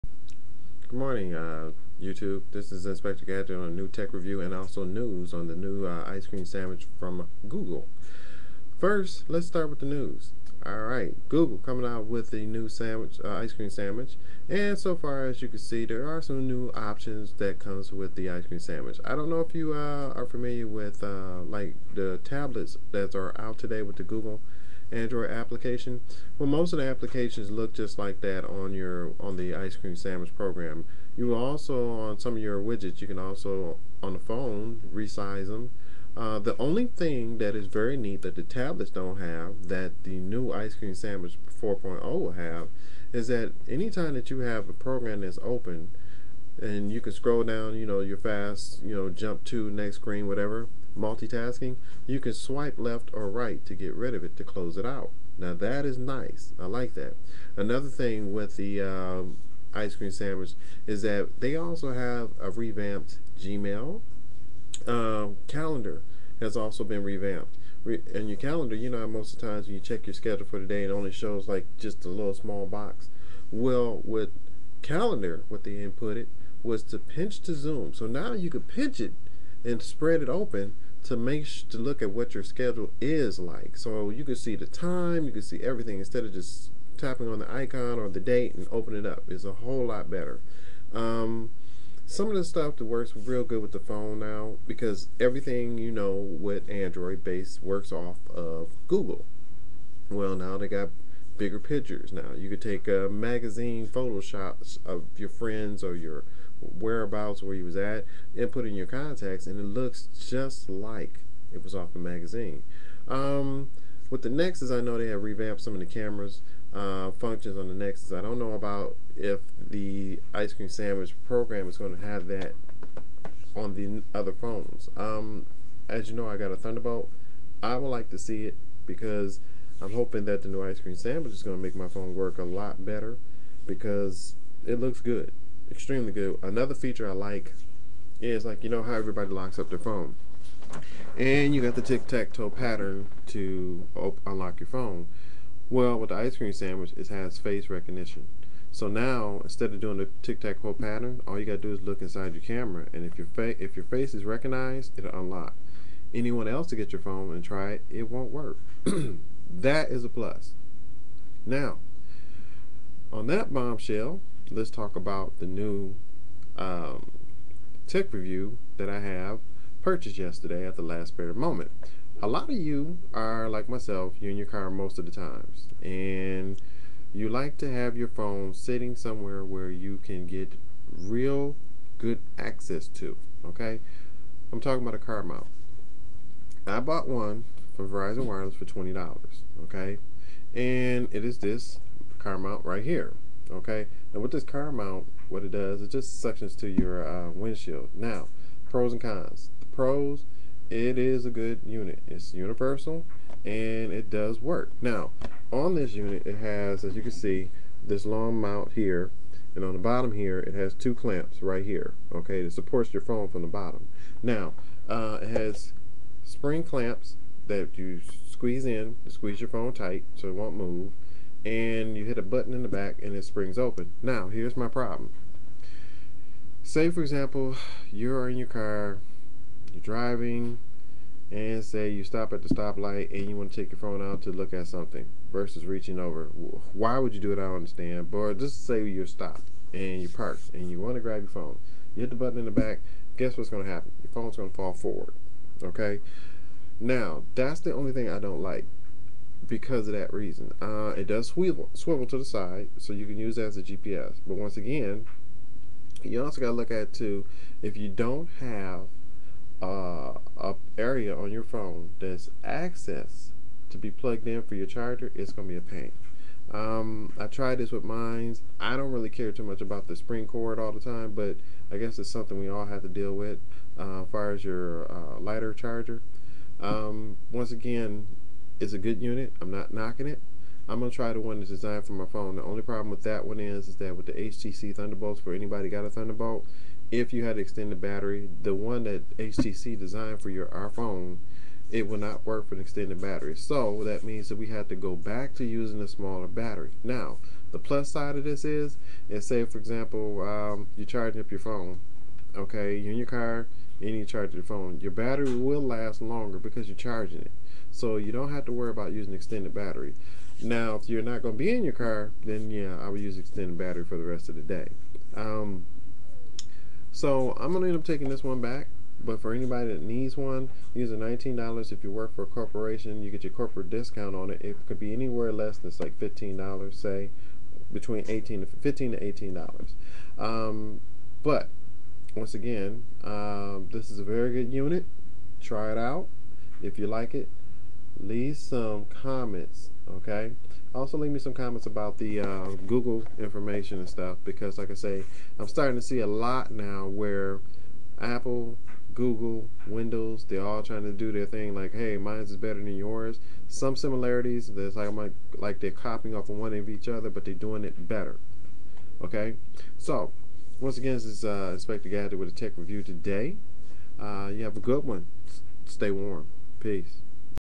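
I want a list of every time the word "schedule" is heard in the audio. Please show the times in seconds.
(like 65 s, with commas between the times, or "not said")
70 s, 82 s.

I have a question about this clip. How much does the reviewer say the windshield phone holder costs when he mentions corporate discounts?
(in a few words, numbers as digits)
$19.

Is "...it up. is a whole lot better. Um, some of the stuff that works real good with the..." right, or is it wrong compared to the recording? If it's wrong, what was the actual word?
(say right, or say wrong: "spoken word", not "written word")
right.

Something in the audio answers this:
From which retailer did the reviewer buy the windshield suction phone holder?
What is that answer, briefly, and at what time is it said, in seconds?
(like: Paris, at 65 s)
Verizon Wireless, at 187 s.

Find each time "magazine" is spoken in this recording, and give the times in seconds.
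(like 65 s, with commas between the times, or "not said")
103 s, 111 s.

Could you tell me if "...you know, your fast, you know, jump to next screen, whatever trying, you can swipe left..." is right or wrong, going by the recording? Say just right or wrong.
wrong.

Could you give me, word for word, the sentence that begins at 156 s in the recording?
Anyone else to get your phone and try it, it won't work.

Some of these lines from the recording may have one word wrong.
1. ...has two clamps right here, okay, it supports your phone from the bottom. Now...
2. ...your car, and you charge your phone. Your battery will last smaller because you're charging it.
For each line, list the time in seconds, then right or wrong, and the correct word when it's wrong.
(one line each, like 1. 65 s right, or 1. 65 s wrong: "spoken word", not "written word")
1. 210 s right
2. 302 s wrong: "longer", not "smaller".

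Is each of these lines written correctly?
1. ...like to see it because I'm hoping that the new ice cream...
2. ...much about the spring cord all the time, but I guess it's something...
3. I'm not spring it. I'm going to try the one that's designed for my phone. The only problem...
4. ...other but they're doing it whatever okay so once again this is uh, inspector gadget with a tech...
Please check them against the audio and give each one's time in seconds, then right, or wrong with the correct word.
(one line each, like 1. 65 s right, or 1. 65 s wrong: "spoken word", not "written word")
1. 127 s right
2. 269 s right
3. 279 s wrong: "knocking", not "spring"
4. 356 s wrong: "better", not "whatever".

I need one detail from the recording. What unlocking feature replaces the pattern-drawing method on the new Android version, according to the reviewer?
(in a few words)
face recognition.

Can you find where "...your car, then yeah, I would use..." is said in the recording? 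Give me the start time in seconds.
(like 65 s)
311 s.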